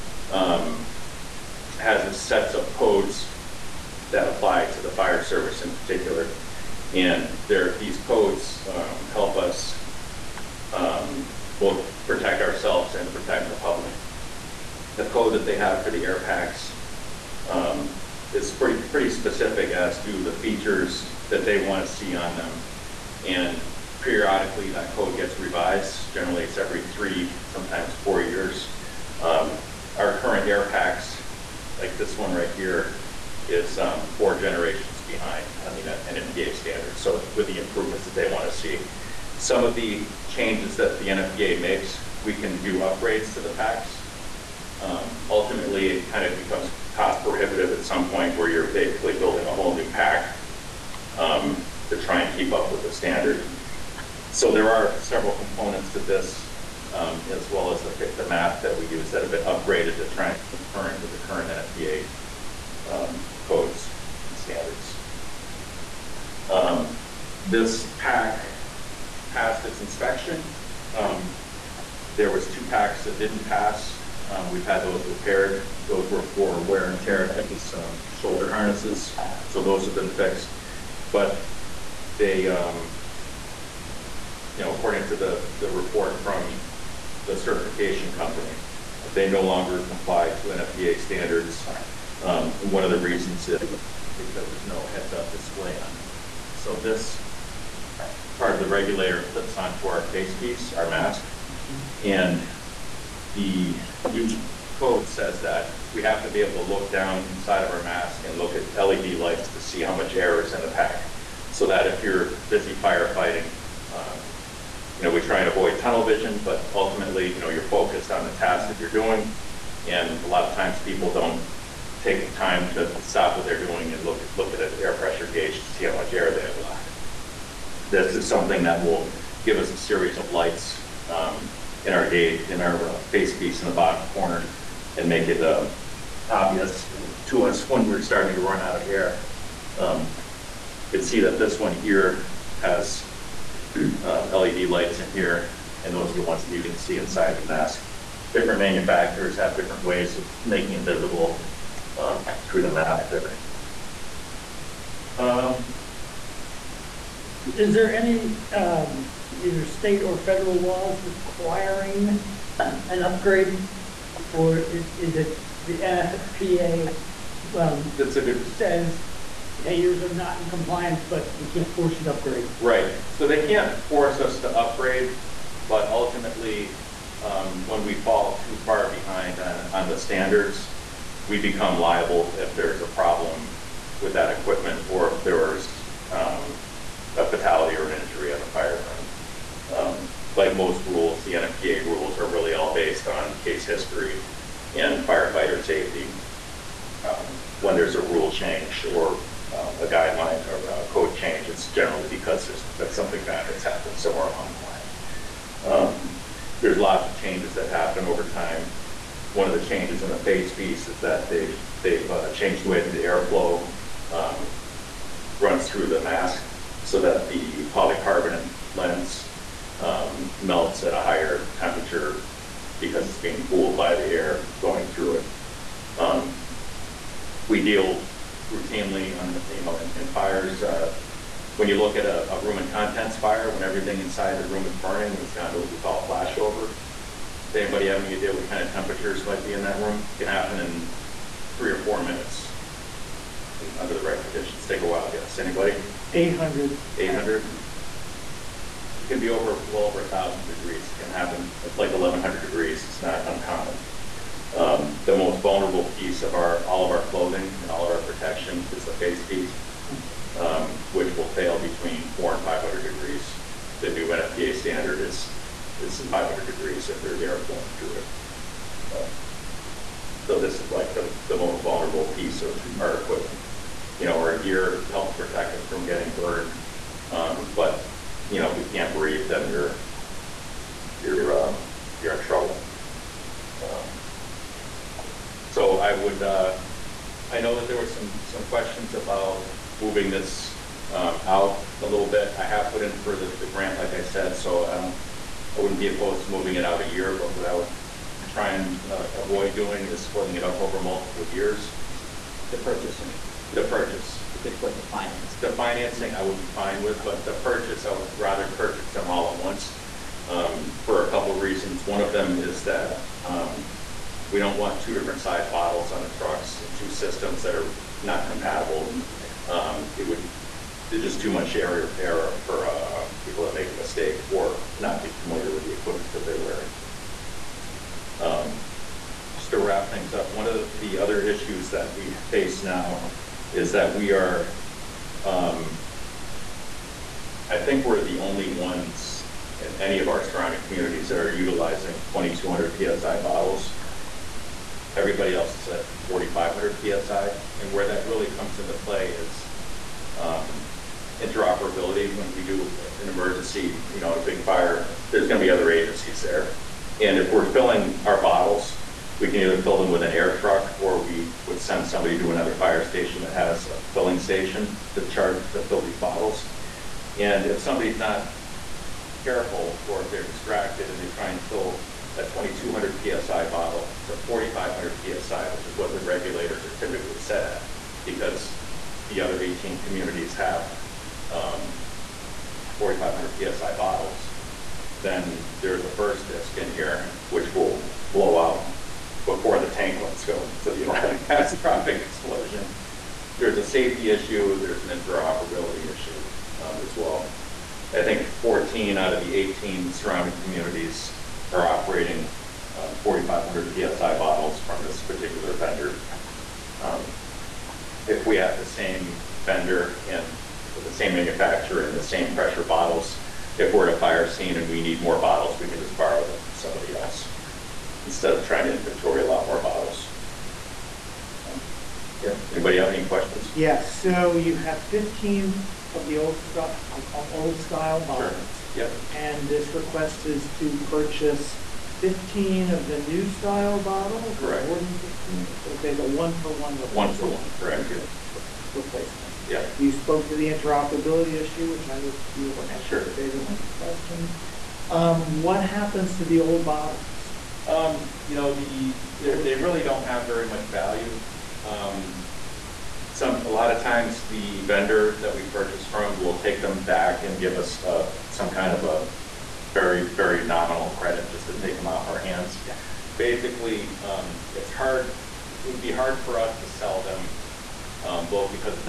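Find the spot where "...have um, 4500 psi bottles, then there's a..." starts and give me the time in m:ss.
6:20.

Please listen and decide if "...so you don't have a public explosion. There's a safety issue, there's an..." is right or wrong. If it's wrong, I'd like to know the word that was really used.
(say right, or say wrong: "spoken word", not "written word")
wrong: "catastrophic", not "public".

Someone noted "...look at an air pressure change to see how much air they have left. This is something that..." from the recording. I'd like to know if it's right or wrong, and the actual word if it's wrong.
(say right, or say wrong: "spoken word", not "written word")
wrong: "gauge", not "change".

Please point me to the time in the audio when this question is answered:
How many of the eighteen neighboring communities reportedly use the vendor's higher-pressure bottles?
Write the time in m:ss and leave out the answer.
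6:38.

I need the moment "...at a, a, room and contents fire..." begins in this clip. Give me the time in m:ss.
3:51.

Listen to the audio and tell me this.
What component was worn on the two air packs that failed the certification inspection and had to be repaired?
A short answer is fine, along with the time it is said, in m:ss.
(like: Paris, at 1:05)
shoulder harnesses, at 1:18.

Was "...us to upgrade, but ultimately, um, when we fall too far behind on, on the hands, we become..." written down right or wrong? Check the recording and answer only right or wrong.
wrong.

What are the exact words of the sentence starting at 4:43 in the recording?
Um, so I would uh, I know that there were some some questions about moving this um, out a little bit.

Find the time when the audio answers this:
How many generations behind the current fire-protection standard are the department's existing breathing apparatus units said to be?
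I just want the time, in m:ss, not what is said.
0:34.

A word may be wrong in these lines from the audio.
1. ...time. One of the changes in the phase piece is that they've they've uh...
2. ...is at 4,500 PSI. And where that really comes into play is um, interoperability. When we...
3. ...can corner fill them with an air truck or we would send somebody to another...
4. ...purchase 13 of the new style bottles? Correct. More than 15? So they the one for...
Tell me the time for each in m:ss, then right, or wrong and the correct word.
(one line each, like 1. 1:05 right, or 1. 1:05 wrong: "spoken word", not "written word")
1. 3:28 right
2. 5:45 right
3. 5:59 wrong: "either", not "corner"
4. 7:10 wrong: "15", not "13".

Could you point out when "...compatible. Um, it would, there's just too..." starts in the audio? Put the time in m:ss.
5:18.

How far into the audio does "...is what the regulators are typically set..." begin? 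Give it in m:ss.
6:15.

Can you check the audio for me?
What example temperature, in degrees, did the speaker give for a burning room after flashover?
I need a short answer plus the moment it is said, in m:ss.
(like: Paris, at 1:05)
1100, at 4:11.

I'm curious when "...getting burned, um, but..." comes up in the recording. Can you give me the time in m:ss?
4:35.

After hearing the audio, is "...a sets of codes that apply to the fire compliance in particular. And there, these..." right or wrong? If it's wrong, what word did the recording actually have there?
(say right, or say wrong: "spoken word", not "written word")
wrong: "service", not "compliance".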